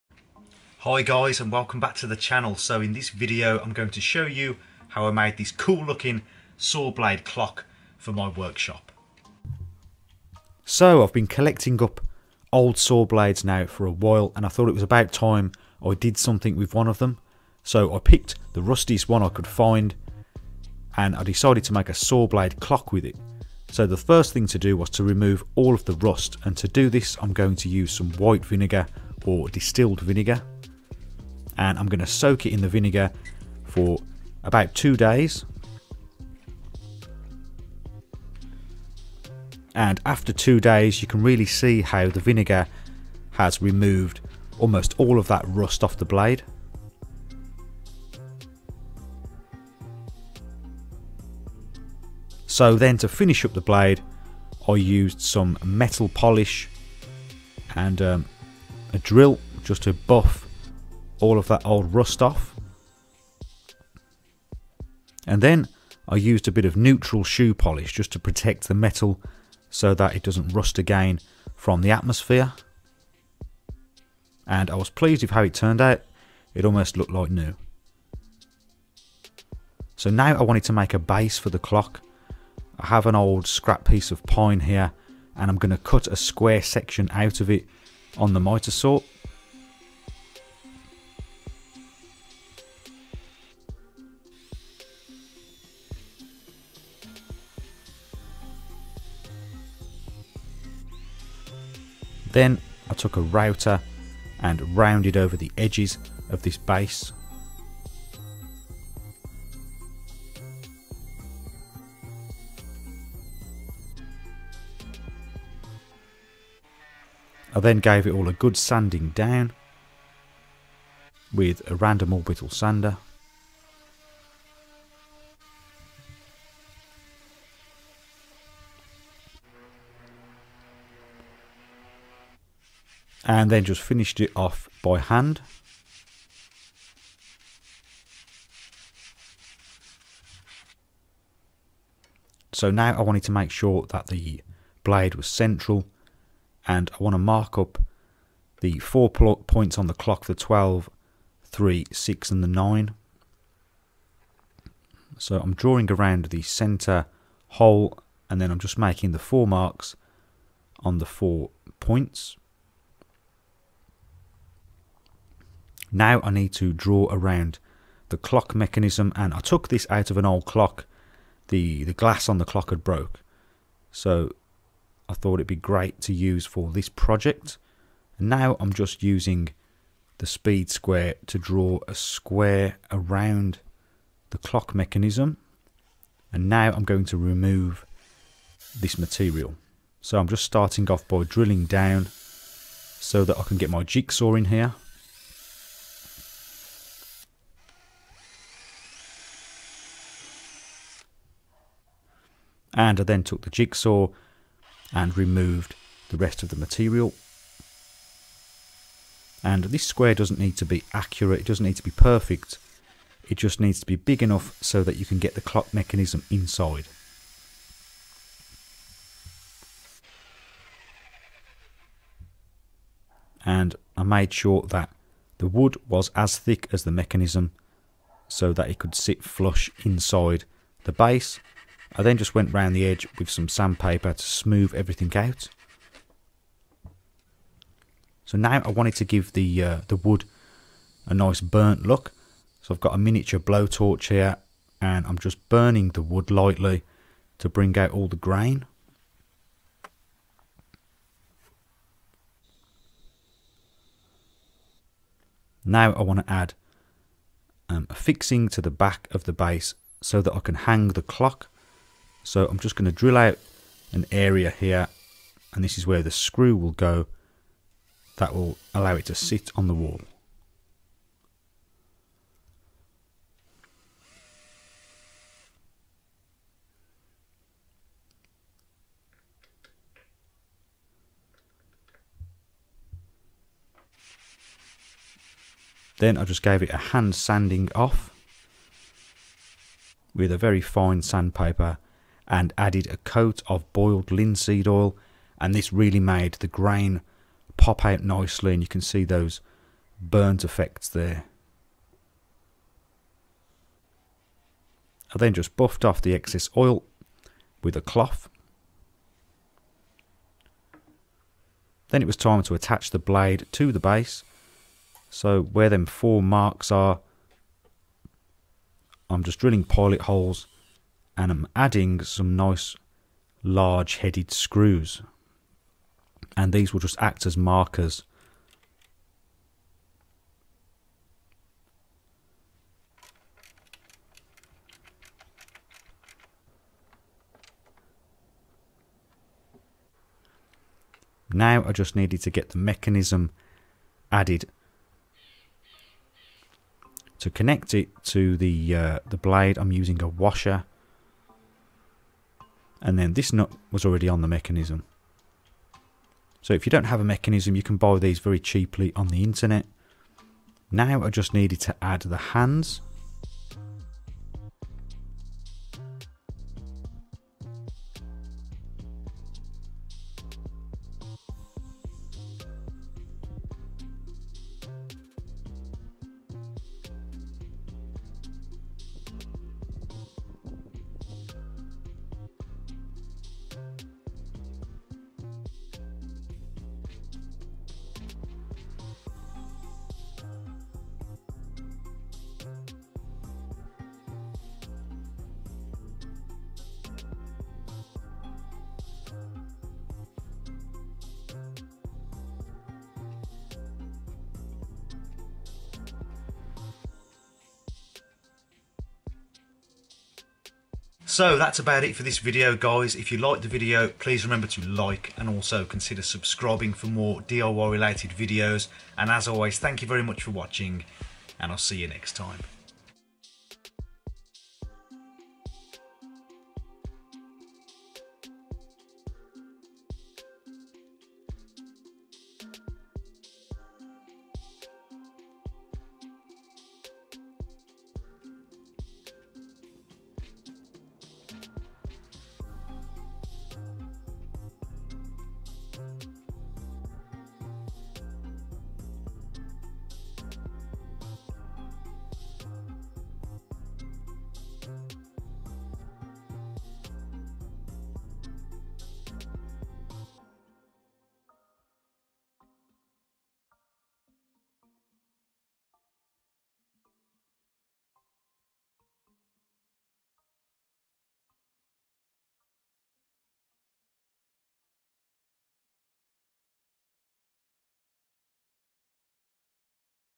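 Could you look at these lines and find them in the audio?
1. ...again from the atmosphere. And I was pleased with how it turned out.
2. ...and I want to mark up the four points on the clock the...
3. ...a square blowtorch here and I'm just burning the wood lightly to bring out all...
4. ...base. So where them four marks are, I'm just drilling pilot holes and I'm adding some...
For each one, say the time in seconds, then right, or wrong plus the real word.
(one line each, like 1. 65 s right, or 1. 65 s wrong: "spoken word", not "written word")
1. 70 s right
2. 146 s right
3. 242 s wrong: "miniature", not "square"
4. 313 s right.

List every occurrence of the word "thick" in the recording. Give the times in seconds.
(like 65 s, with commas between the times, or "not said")
226 s.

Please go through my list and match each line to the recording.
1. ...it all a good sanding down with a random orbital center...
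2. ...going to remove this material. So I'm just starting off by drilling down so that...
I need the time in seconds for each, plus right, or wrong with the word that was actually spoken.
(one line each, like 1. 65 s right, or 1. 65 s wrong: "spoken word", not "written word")
1. 118 s wrong: "sander", not "center"
2. 186 s right.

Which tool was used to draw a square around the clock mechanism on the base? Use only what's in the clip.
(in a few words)
speed square.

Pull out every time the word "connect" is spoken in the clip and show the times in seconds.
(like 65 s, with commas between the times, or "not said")
347 s.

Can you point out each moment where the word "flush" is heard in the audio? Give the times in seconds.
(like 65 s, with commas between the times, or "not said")
229 s.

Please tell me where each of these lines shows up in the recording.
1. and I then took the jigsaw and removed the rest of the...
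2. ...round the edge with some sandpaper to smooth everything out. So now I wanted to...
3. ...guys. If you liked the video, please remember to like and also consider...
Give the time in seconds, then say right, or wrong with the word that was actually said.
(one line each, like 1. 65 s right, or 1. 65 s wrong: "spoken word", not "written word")
1. 202 s right
2. 232 s right
3. 412 s right.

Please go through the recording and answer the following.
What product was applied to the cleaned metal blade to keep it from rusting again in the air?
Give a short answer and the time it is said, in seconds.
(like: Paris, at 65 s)
neutral shoe polish, at 66 s.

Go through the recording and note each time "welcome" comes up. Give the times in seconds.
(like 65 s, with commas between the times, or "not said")
1 s.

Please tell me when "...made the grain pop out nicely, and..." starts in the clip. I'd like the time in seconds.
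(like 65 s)
295 s.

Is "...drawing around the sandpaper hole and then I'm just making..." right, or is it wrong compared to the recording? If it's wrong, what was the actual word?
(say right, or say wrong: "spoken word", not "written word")
wrong: "center", not "sandpaper".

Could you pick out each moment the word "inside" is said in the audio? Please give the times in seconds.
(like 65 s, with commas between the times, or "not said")
216 s, 229 s.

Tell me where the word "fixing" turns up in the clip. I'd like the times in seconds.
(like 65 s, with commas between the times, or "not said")
257 s.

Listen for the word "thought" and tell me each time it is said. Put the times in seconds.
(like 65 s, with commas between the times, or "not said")
14 s, 175 s.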